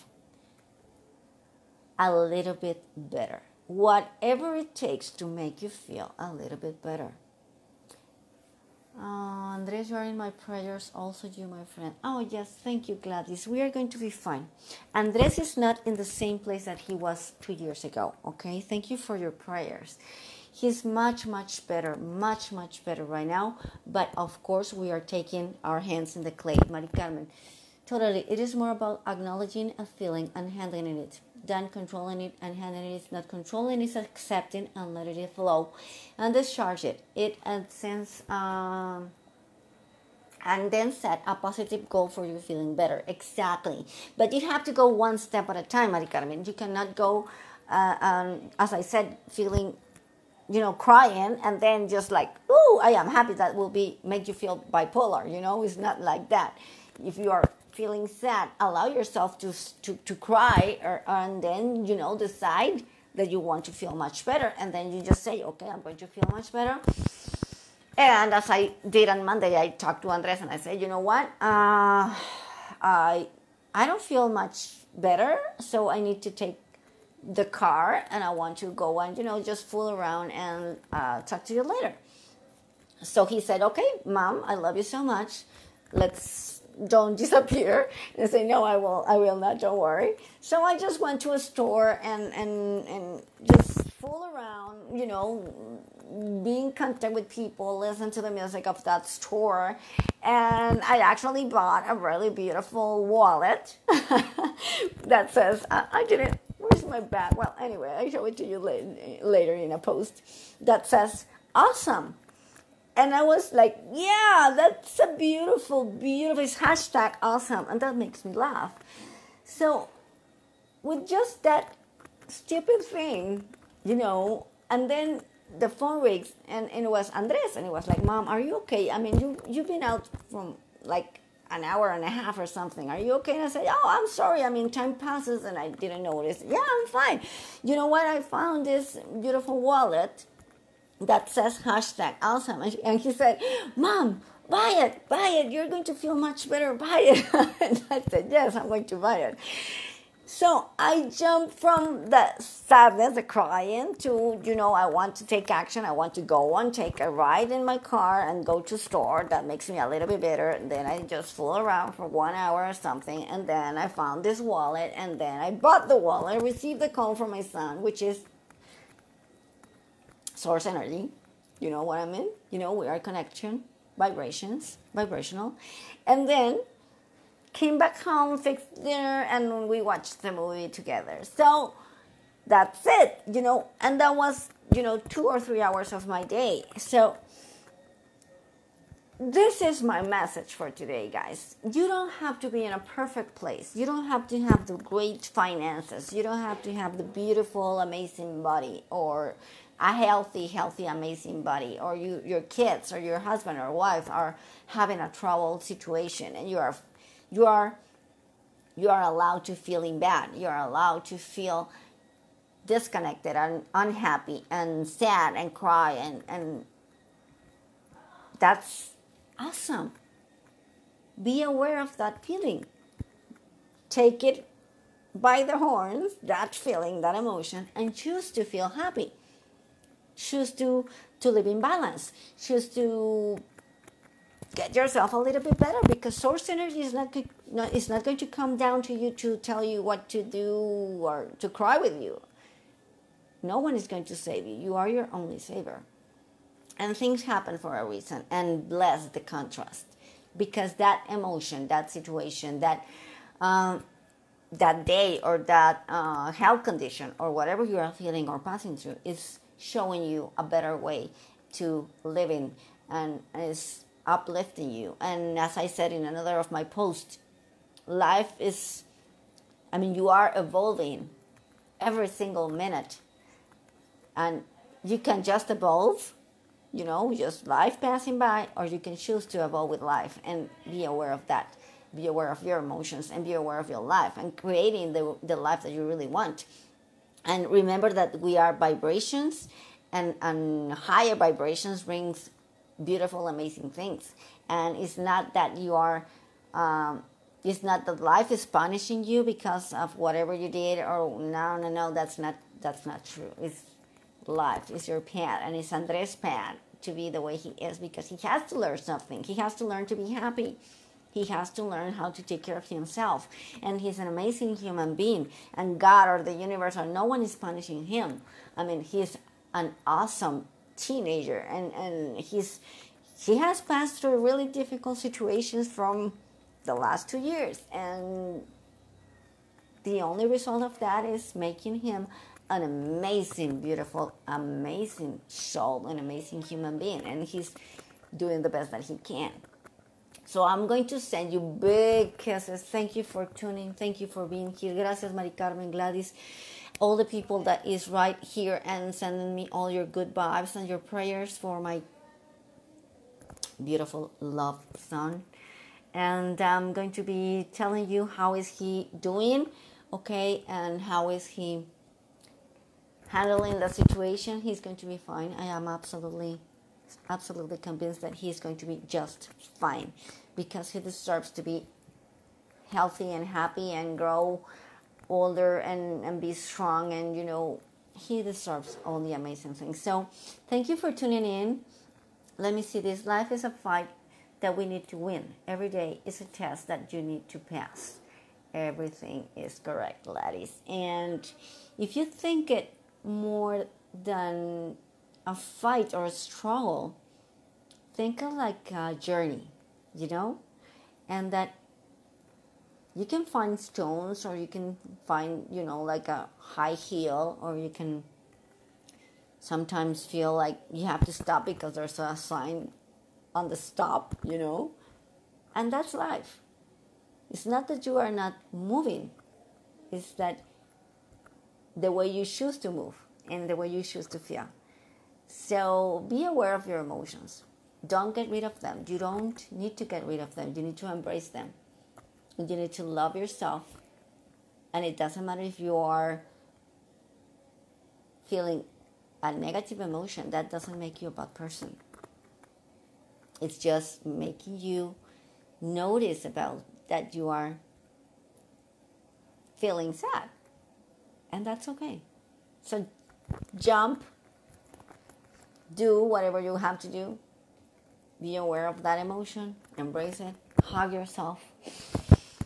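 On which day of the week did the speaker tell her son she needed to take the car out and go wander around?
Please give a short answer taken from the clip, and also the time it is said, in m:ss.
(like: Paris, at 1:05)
Monday, at 1:09.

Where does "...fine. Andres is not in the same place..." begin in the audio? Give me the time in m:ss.
0:14.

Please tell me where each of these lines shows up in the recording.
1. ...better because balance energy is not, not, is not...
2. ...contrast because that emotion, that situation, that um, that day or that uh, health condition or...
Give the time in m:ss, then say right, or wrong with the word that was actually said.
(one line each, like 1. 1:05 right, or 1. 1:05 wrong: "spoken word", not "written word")
1. 3:55 wrong: "source", not "balance"
2. 4:09 right.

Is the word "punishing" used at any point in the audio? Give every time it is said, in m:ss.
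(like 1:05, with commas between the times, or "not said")
4:58, 5:17.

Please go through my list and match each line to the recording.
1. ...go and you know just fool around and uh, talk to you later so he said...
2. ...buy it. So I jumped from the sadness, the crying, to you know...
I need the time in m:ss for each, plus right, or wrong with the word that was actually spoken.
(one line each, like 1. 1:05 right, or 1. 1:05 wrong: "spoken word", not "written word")
1. 1:18 right
2. 2:28 right.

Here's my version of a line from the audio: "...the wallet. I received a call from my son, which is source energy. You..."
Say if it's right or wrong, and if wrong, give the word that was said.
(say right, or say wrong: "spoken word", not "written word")
right.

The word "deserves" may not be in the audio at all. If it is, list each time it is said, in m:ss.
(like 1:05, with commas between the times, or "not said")
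6:10, 6:18.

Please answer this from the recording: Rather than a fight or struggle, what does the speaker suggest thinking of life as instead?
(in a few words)
a journey.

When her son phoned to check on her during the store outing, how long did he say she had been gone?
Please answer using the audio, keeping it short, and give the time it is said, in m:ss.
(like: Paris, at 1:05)
an hour and a half, at 2:11.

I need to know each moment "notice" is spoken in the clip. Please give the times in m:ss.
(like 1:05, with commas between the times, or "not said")
2:16, 7:25.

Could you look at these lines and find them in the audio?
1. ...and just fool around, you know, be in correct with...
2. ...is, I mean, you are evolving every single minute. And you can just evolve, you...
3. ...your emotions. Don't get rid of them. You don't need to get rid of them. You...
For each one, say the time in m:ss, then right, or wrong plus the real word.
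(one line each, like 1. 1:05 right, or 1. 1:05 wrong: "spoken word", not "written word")
1. 1:32 wrong: "contact", not "correct"
2. 4:28 right
3. 7:06 right.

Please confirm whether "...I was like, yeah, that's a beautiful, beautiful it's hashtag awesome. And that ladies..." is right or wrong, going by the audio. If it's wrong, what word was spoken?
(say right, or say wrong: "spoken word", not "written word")
wrong: "makes", not "ladies".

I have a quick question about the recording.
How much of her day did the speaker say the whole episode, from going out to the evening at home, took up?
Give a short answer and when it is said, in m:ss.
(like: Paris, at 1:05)
2 or 3 hours, at 3:04.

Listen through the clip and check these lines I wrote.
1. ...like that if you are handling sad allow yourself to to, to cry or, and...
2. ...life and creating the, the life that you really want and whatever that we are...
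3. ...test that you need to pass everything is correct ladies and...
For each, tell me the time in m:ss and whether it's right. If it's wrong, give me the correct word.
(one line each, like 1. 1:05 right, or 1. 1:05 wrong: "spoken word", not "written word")
1. 0:55 wrong: "feeling", not "handling"
2. 4:43 wrong: "remember", not "whatever"
3. 6:26 right.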